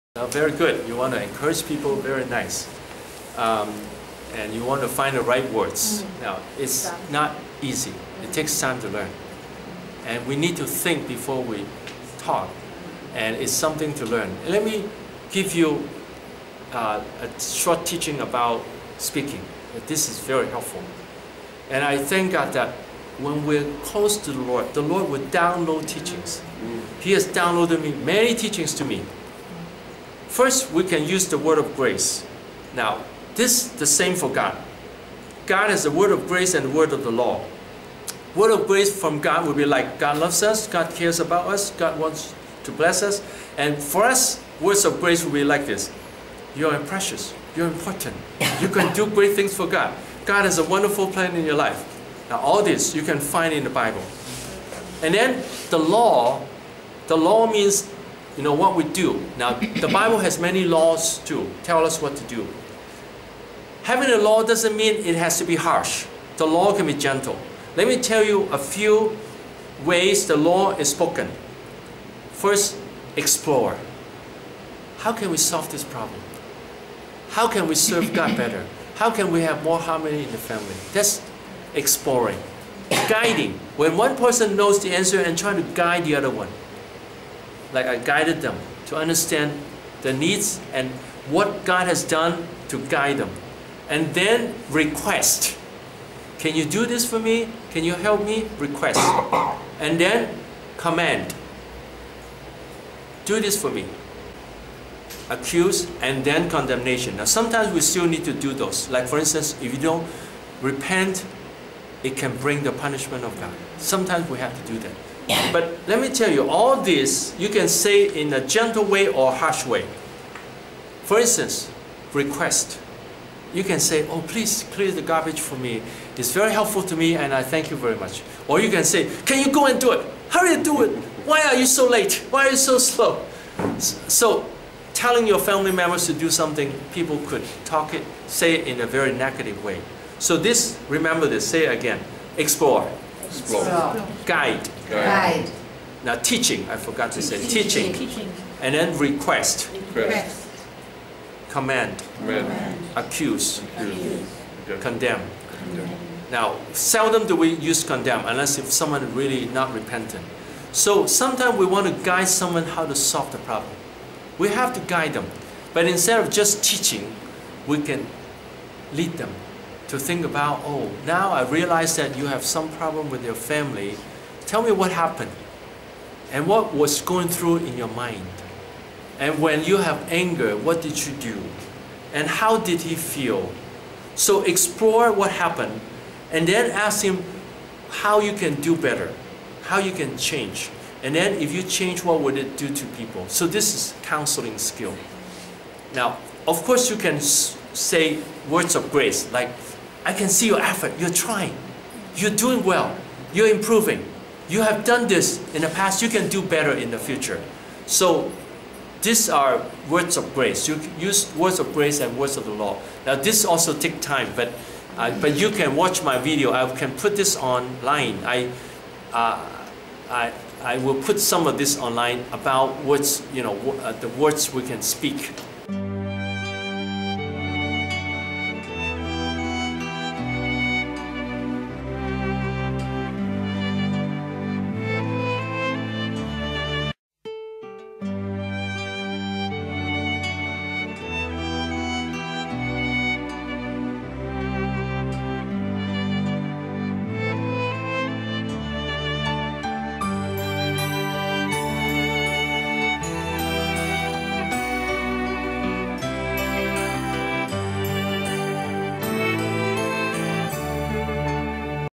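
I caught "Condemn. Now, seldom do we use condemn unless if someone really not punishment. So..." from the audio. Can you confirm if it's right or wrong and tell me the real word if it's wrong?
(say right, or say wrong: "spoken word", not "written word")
wrong: "repentant", not "punishment".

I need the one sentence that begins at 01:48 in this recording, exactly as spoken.
Like for instance, if you don't repent, it can bring the punishment of God.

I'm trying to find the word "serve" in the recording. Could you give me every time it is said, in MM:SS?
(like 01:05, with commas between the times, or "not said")
01:17.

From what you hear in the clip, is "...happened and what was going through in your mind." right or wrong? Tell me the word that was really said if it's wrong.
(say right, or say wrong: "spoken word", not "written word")
right.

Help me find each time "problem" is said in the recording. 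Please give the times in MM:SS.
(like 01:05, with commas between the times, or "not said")
01:15, 02:43, 02:52.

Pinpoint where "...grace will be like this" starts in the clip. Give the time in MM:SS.
00:45.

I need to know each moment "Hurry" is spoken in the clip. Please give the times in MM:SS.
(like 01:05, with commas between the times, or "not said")
02:10.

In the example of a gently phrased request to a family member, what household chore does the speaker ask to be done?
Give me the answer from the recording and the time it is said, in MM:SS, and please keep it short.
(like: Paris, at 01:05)
clear the garbage, at 02:04.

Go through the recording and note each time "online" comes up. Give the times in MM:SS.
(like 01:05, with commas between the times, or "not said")
03:37, 03:41.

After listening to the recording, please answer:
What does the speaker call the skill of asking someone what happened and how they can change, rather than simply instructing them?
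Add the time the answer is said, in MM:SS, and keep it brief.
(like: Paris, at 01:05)
counseling skill, at 03:14.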